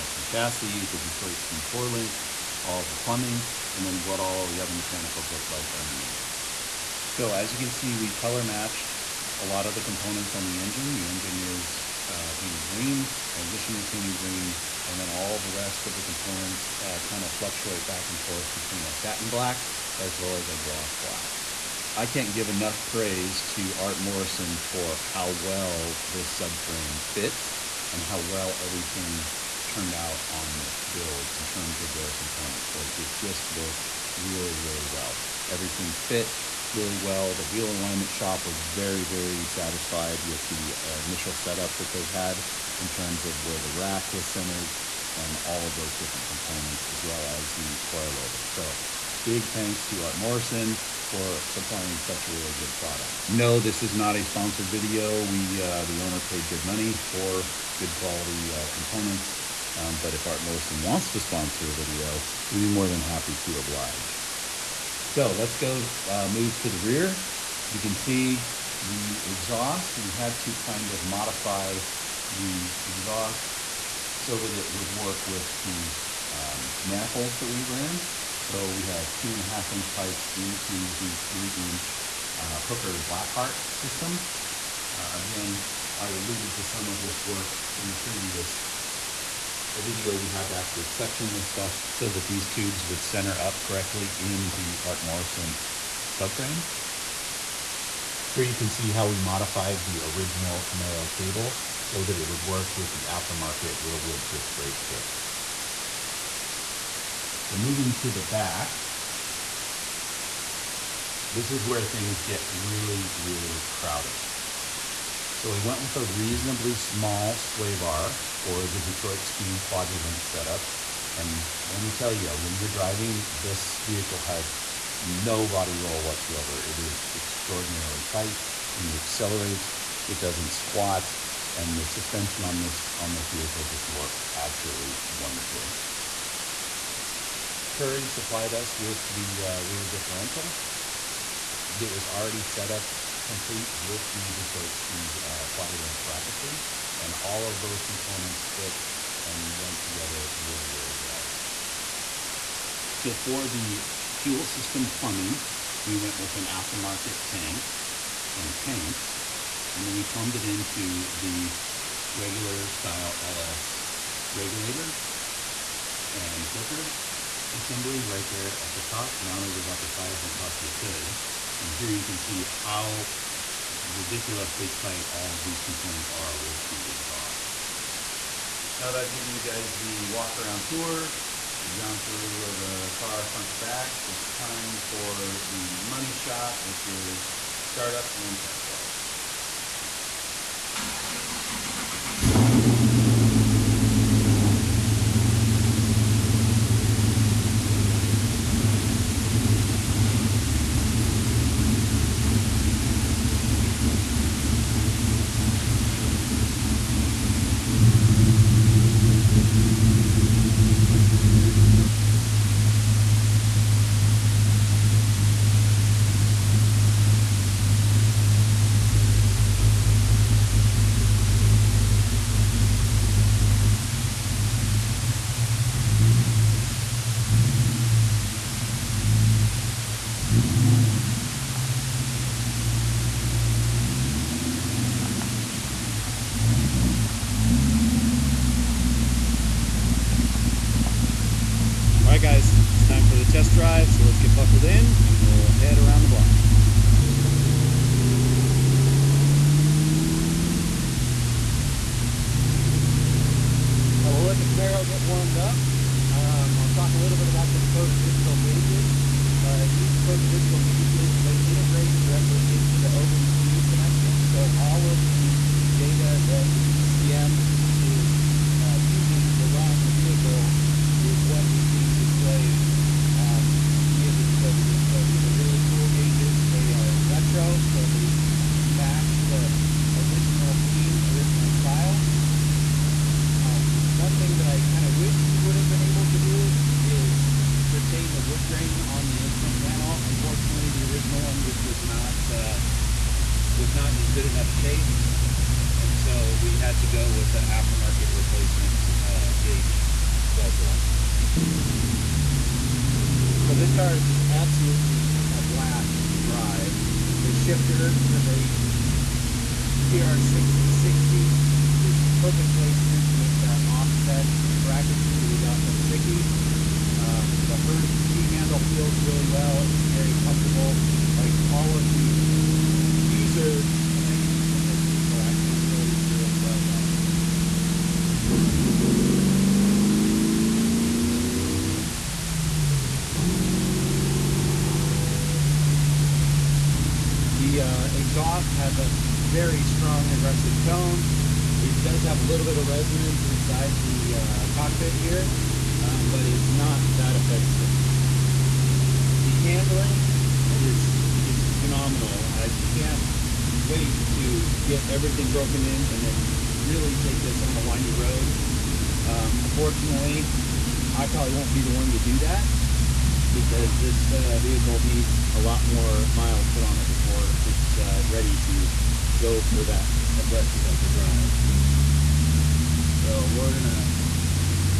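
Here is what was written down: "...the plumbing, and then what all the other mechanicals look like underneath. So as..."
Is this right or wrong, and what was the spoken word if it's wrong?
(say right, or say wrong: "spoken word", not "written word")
right.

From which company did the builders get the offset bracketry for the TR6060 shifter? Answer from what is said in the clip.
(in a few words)
Sikky.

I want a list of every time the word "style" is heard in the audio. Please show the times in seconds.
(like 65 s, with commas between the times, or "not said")
162 s, 281 s.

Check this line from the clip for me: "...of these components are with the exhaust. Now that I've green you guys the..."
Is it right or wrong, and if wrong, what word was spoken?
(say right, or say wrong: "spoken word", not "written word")
wrong: "given", not "green".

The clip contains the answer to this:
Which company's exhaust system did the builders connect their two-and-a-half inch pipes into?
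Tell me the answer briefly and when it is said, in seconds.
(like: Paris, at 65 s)
Hooker Blackheart, at 82 s.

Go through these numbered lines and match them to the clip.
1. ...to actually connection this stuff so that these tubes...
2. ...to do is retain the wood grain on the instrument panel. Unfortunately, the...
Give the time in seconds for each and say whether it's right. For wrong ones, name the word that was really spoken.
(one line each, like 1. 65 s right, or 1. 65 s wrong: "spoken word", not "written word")
1. 90 s wrong: "section", not "connection"
2. 286 s right.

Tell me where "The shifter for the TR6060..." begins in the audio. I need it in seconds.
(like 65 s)
307 s.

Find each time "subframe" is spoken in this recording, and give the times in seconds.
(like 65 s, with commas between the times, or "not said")
26 s, 96 s.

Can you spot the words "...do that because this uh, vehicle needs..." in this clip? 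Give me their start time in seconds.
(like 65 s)
361 s.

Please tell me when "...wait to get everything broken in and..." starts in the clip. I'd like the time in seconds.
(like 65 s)
353 s.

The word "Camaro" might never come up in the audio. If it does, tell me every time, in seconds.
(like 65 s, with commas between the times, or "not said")
100 s, 254 s.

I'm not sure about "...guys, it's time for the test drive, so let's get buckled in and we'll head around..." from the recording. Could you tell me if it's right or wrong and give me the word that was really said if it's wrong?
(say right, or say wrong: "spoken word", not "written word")
right.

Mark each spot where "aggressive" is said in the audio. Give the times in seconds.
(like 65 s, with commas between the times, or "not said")
340 s, 370 s.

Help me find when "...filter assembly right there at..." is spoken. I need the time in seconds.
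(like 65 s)
166 s.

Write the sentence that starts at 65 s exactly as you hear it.
So let's go uh, move to the rear.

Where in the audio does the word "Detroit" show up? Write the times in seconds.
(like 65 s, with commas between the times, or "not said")
0 s, 118 s, 144 s.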